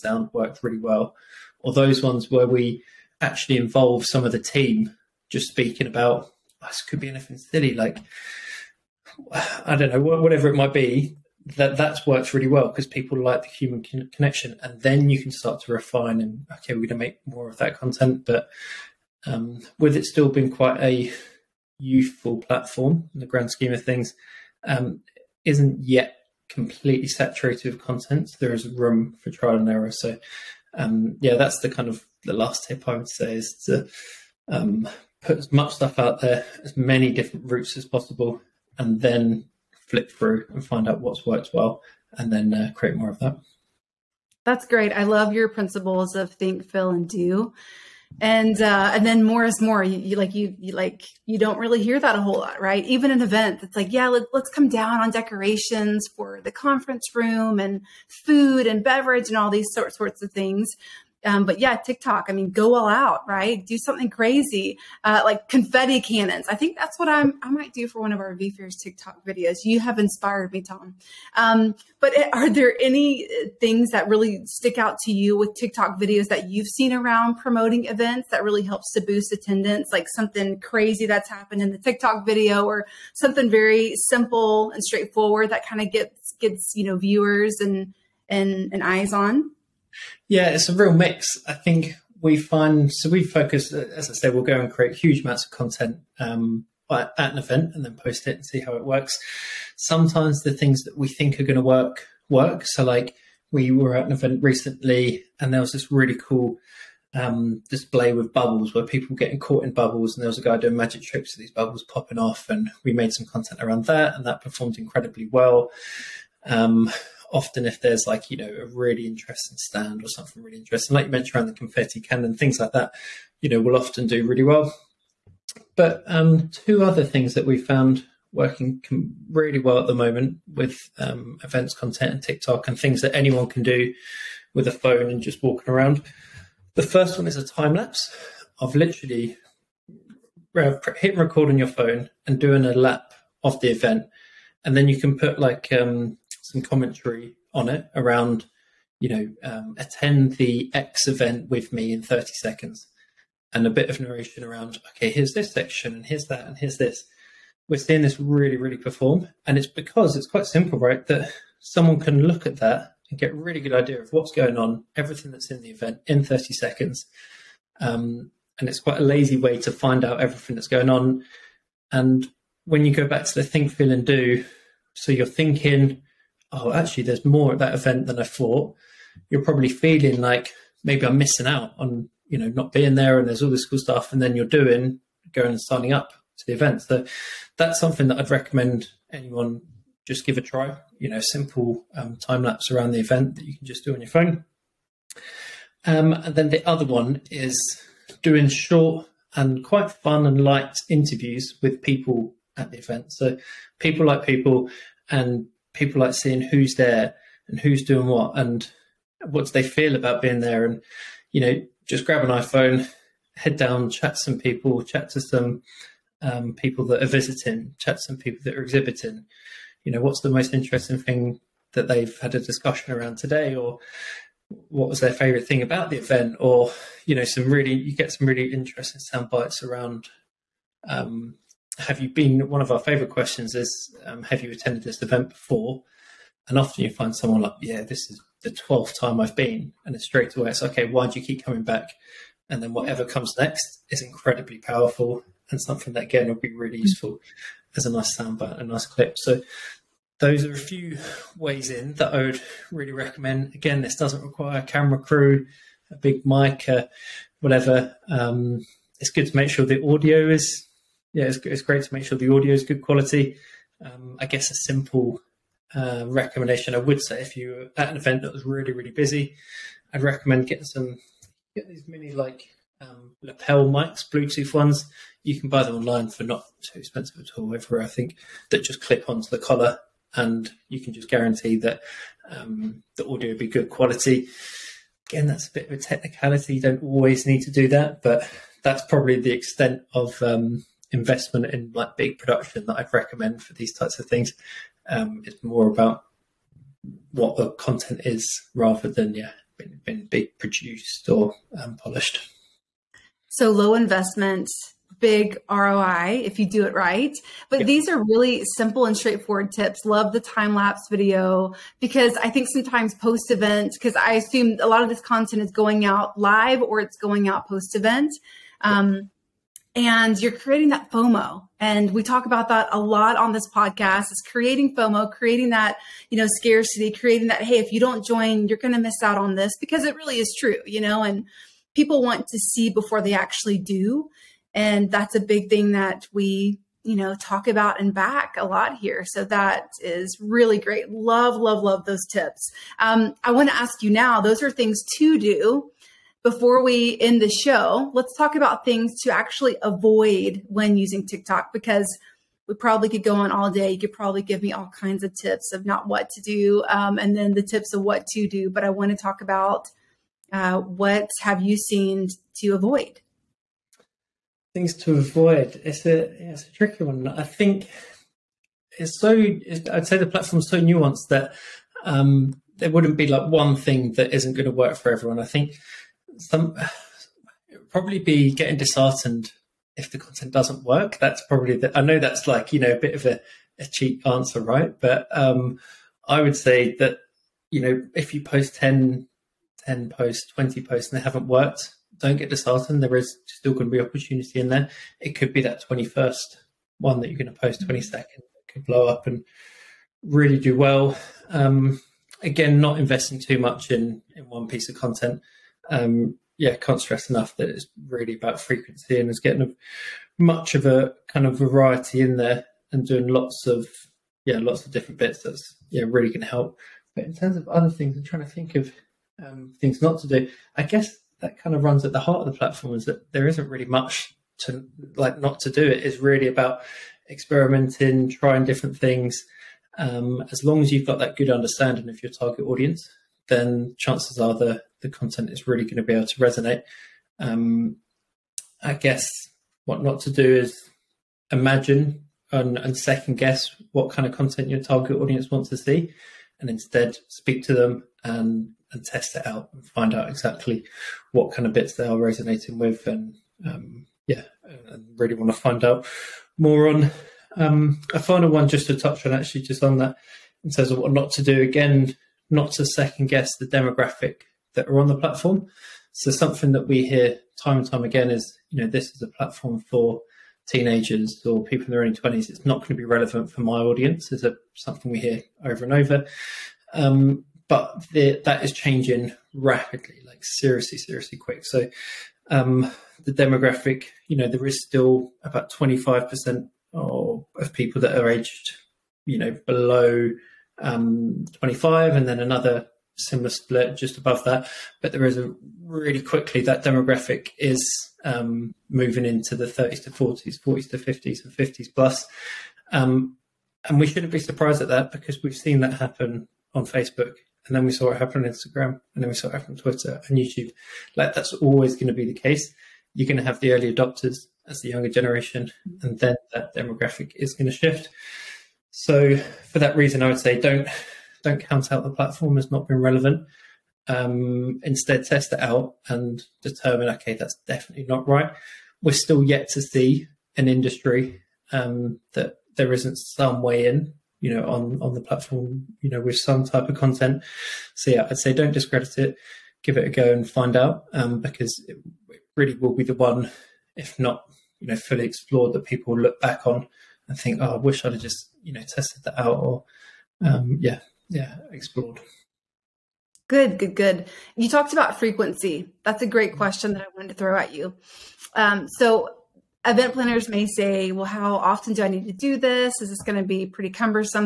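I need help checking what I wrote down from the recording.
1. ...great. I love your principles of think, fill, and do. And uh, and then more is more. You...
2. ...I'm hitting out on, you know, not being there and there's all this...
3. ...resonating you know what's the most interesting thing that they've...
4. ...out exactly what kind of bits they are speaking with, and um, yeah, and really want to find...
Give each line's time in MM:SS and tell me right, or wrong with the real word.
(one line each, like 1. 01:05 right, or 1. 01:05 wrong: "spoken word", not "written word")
1. 00:44 right
2. 03:01 wrong: "missing", not "hitting"
3. 03:38 wrong: "exhibiting", not "resonating"
4. 07:29 wrong: "resonating", not "speaking".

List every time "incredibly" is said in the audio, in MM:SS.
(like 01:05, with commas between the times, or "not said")
01:54, 04:04.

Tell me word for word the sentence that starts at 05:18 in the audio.
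Um, and you're creating that FOMO.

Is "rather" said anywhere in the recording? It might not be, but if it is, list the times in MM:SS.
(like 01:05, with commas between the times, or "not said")
04:58.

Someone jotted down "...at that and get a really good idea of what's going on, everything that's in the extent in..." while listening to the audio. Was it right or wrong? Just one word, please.
wrong.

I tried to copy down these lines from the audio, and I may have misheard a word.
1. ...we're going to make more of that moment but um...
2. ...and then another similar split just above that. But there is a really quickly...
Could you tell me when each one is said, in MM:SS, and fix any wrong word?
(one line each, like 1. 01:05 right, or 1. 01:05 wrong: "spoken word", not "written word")
1. 00:16 wrong: "content", not "moment"
2. 08:11 right.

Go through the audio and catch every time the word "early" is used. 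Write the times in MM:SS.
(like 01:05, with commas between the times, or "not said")
07:51, 08:33.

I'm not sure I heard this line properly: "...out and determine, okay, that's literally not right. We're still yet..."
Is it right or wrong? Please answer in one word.
wrong.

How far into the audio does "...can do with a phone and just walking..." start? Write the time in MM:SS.
02:13.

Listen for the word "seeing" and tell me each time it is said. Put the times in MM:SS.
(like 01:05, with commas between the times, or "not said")
02:37, 03:26.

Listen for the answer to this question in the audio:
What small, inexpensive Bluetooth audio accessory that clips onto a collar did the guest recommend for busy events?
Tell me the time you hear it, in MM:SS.
04:33.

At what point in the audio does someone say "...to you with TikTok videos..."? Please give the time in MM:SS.
01:15.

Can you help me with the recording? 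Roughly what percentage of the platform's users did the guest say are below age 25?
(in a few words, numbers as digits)
25%.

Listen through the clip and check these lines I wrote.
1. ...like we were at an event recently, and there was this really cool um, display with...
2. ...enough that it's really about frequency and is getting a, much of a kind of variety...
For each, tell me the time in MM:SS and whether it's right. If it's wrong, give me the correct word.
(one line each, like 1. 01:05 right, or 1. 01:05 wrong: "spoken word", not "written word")
1. 01:42 right
2. 06:47 right.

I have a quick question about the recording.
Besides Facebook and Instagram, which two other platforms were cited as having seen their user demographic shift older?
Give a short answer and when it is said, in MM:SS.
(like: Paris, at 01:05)
Twitter and YouTube, at 08:29.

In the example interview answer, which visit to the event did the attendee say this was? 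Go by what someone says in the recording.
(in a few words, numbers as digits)
12th time.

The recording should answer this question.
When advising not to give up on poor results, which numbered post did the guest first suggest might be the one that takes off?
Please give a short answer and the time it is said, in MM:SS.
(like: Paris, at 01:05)
21st, at 06:35.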